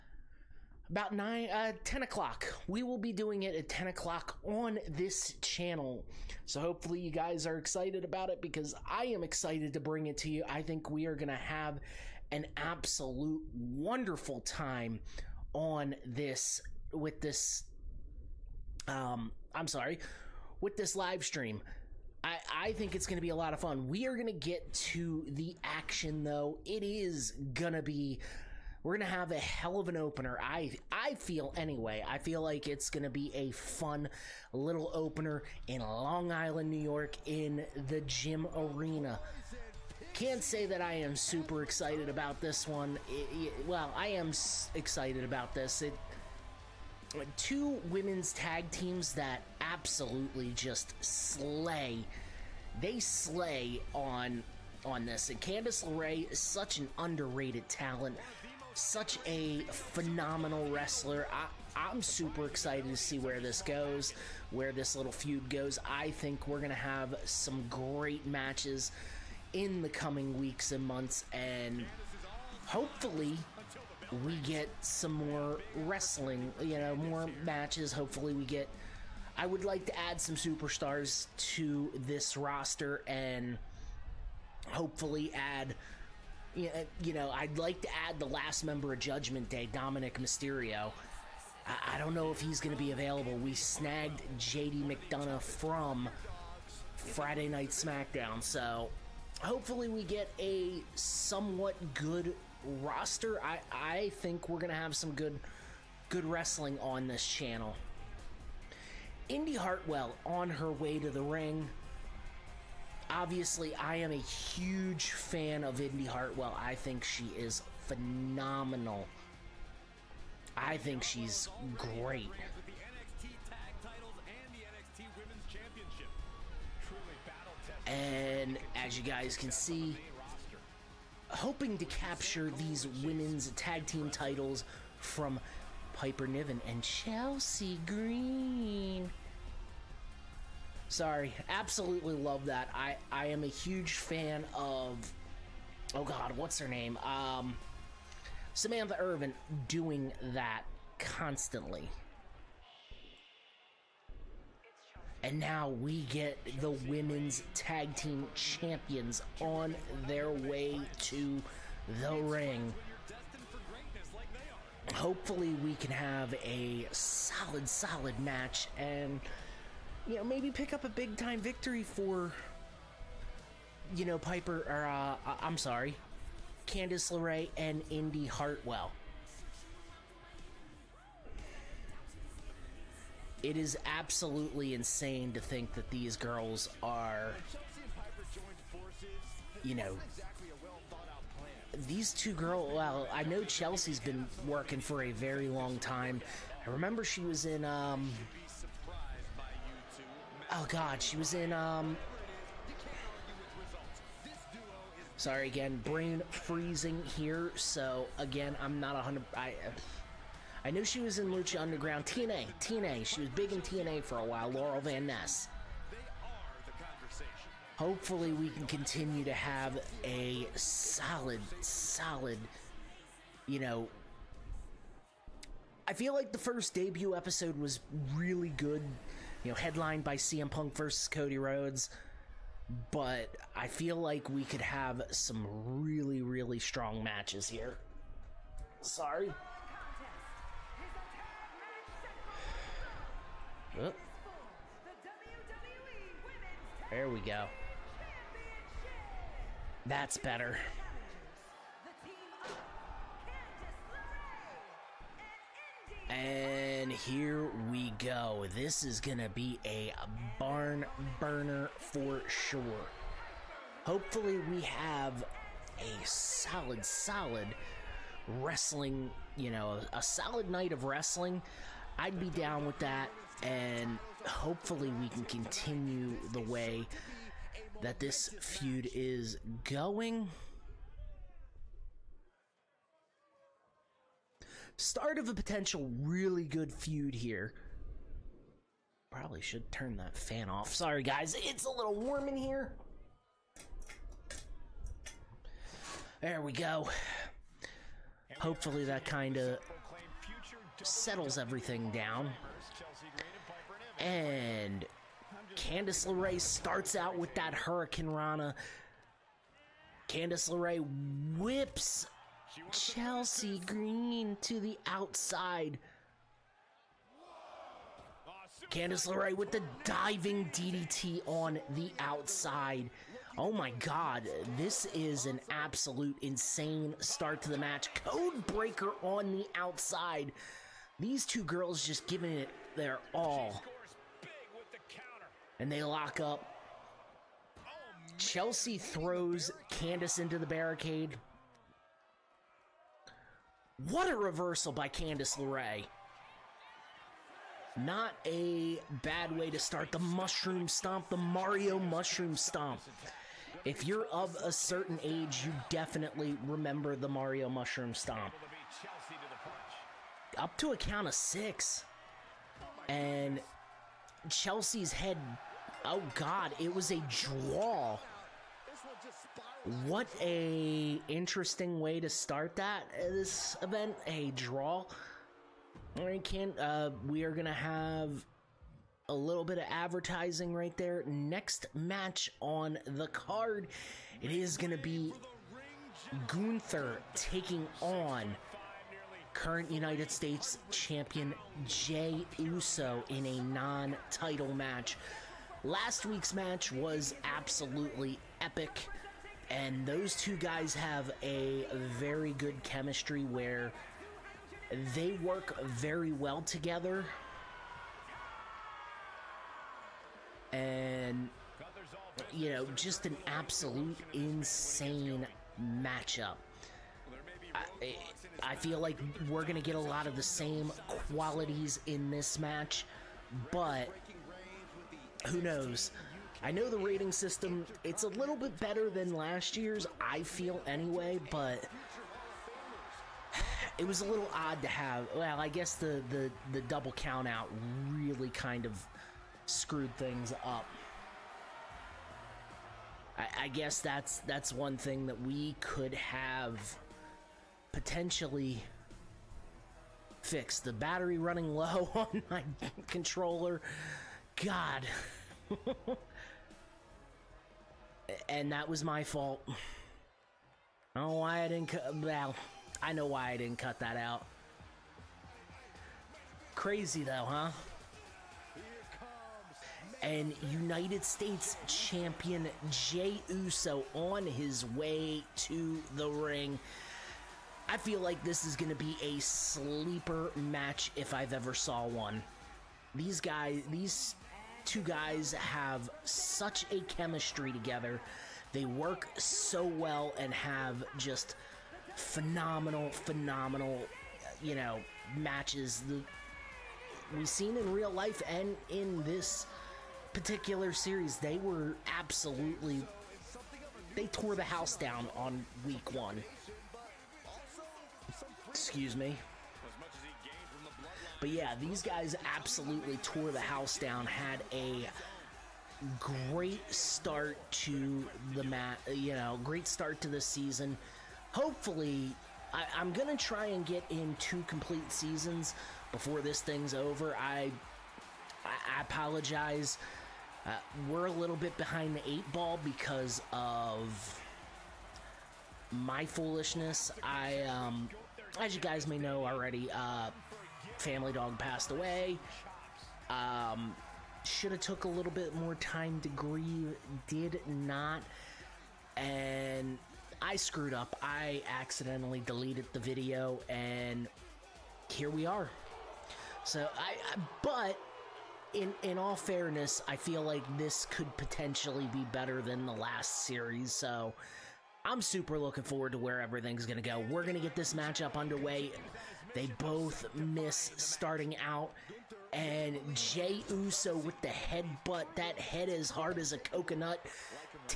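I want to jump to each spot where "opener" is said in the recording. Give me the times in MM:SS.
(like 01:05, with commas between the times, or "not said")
00:29, 00:34.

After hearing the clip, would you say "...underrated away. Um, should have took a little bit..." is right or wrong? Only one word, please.
wrong.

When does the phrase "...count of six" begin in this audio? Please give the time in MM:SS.
06:00.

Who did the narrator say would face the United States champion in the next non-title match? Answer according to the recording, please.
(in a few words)
Gunther.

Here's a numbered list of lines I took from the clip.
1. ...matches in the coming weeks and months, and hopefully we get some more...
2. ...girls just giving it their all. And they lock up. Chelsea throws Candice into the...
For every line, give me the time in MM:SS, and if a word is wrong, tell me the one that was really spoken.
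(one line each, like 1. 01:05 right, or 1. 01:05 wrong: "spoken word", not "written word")
1. 01:08 right
2. 05:31 right.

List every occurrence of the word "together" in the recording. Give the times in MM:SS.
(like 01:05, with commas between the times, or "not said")
06:46, 08:07.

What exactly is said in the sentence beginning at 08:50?
Uh, we're a little bit behind the eight ball because of my foolishness.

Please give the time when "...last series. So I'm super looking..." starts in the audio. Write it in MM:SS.
09:22.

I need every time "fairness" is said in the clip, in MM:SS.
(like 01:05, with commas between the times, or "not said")
09:19.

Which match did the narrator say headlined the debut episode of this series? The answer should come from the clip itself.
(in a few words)
CM Punk versus Cody Rhodes.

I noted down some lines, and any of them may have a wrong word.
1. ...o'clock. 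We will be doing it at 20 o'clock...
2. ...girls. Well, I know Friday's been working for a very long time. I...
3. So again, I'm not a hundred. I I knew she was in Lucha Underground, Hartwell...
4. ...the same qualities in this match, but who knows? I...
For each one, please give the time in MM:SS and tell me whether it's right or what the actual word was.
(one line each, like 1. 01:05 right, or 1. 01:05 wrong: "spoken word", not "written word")
1. 00:02 wrong: "10", not "20"
2. 03:12 wrong: "Chelsea", not "Friday"
3. 03:27 wrong: "TNA", not "Hartwell"
4. 07:00 right.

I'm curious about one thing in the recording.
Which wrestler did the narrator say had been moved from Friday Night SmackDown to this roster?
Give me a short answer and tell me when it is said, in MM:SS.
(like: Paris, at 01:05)
JD McDonagh, at 01:34.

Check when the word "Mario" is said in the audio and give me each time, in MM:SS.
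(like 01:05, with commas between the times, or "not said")
05:51, 05:57.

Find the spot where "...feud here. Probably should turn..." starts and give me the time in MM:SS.
04:46.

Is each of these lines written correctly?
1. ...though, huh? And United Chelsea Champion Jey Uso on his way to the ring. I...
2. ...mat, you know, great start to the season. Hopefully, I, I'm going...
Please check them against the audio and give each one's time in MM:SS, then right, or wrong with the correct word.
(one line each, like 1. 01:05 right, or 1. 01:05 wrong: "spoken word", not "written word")
1. 07:47 wrong: "States", not "Chelsea"
2. 08:38 right.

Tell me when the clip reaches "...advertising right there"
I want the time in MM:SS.
06:19.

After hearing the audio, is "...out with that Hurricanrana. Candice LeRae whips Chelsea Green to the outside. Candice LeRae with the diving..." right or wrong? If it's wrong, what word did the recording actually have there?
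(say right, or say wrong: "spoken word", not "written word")
right.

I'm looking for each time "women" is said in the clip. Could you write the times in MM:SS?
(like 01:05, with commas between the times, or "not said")
00:47, 02:13, 02:36.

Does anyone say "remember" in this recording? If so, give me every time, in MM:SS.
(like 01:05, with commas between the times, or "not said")
03:16, 05:56.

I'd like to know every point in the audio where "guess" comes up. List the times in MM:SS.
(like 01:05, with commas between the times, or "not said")
07:15, 07:23.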